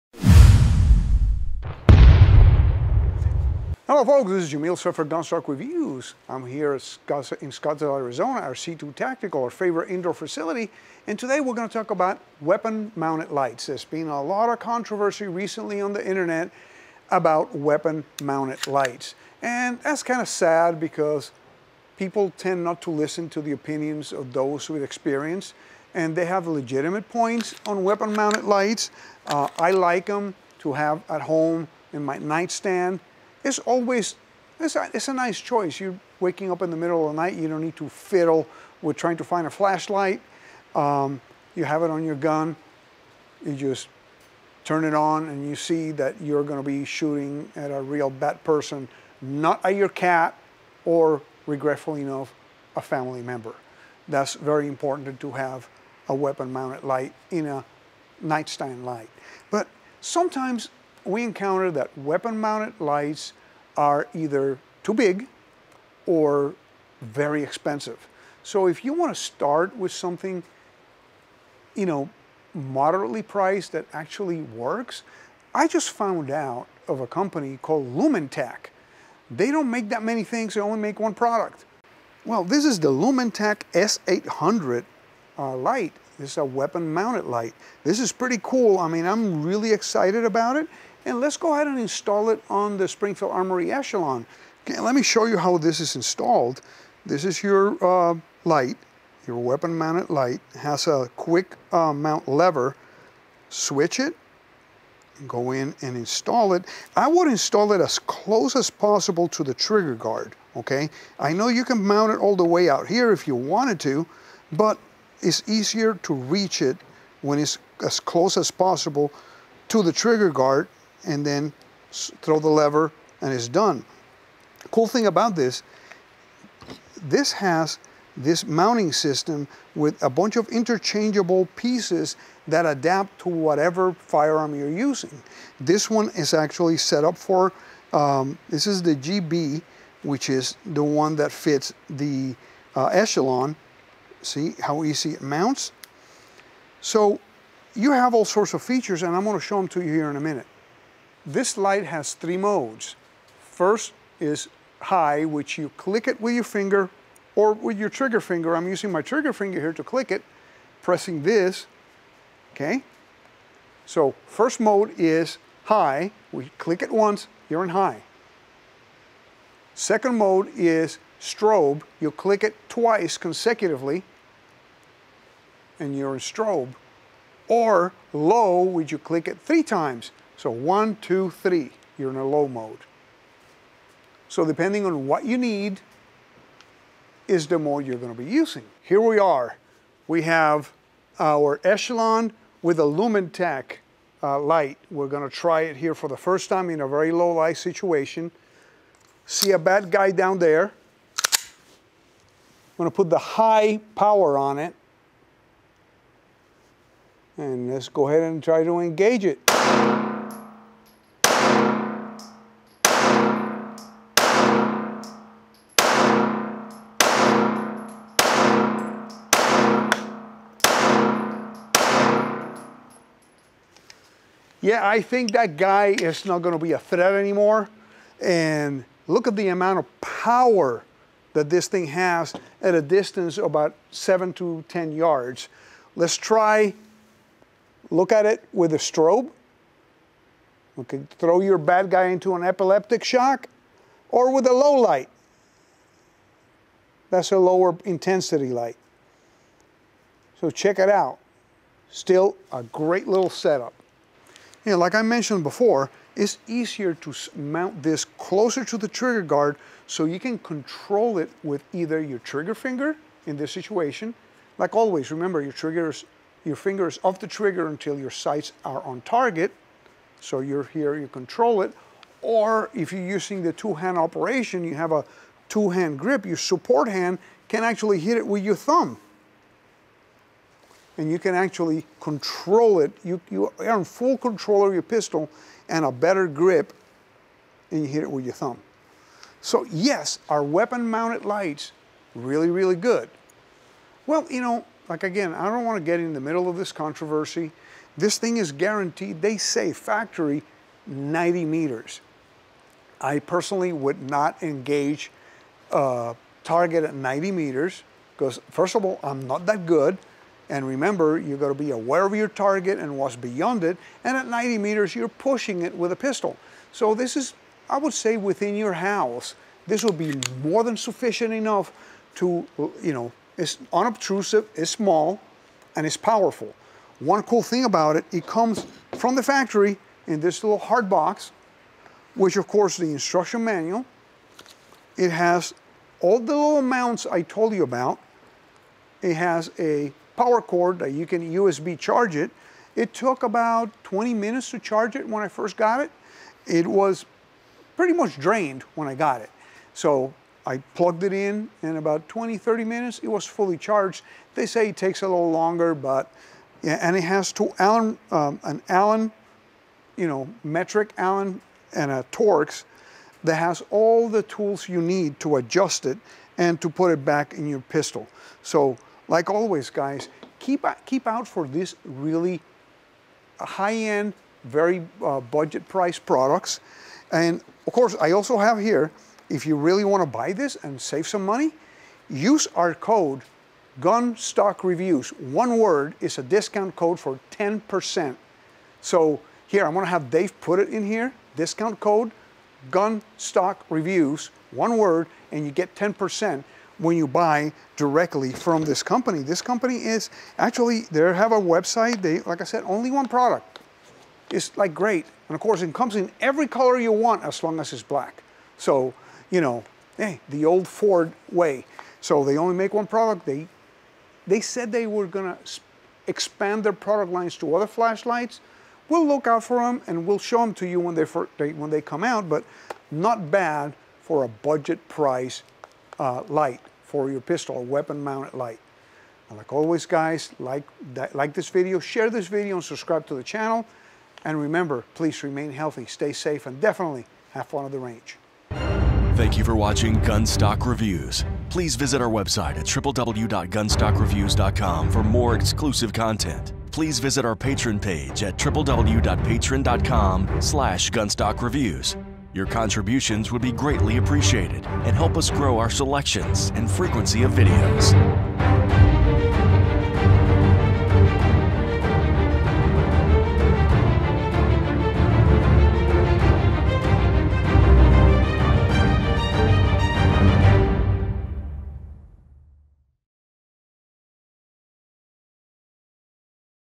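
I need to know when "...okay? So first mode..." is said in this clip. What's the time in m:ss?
2:42.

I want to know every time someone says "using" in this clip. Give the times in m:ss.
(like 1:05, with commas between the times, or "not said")
2:14, 2:38, 3:08, 4:33.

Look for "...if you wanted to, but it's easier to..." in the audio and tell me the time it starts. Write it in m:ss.
1:53.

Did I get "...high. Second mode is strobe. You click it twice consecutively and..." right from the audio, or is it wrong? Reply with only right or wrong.
right.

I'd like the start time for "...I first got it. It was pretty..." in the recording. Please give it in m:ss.
5:45.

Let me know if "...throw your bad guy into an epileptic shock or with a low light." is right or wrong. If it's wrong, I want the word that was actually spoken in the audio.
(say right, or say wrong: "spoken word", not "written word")
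right.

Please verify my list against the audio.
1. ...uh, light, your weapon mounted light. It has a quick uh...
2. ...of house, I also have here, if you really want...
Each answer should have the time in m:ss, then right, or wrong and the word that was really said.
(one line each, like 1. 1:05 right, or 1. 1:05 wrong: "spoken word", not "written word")
1. 1:37 right
2. 6:17 wrong: "course", not "house".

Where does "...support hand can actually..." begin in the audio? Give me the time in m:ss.
4:36.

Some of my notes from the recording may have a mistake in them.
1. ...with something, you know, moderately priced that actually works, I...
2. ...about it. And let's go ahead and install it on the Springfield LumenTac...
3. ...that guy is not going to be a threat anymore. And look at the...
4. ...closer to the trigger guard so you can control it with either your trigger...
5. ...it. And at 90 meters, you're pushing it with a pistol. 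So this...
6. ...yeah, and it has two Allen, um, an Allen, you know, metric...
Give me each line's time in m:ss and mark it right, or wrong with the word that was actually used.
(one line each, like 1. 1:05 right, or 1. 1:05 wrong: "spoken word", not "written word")
1. 1:09 right
2. 1:30 wrong: "Armory", not "LumenTac"
3. 3:45 right
4. 4:18 right
5. 5:13 right
6. 5:56 right.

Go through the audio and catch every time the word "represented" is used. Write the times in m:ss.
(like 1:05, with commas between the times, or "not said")
not said.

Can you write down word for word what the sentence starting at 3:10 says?
We have our Echelon with a LumenTac uh, light.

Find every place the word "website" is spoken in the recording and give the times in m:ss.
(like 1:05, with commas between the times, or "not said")
6:41, 7:22.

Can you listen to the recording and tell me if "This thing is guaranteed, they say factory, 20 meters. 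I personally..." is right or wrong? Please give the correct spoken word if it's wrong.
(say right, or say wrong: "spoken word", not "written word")
wrong: "90", not "20".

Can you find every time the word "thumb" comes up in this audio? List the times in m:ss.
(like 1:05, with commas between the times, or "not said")
4:38, 4:48.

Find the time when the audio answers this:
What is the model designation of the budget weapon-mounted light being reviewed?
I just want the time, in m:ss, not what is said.
1:23.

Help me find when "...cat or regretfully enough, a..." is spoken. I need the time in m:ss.
0:49.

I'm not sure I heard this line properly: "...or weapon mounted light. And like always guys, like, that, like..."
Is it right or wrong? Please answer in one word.
right.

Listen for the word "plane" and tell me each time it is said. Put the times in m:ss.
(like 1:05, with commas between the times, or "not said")
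not said.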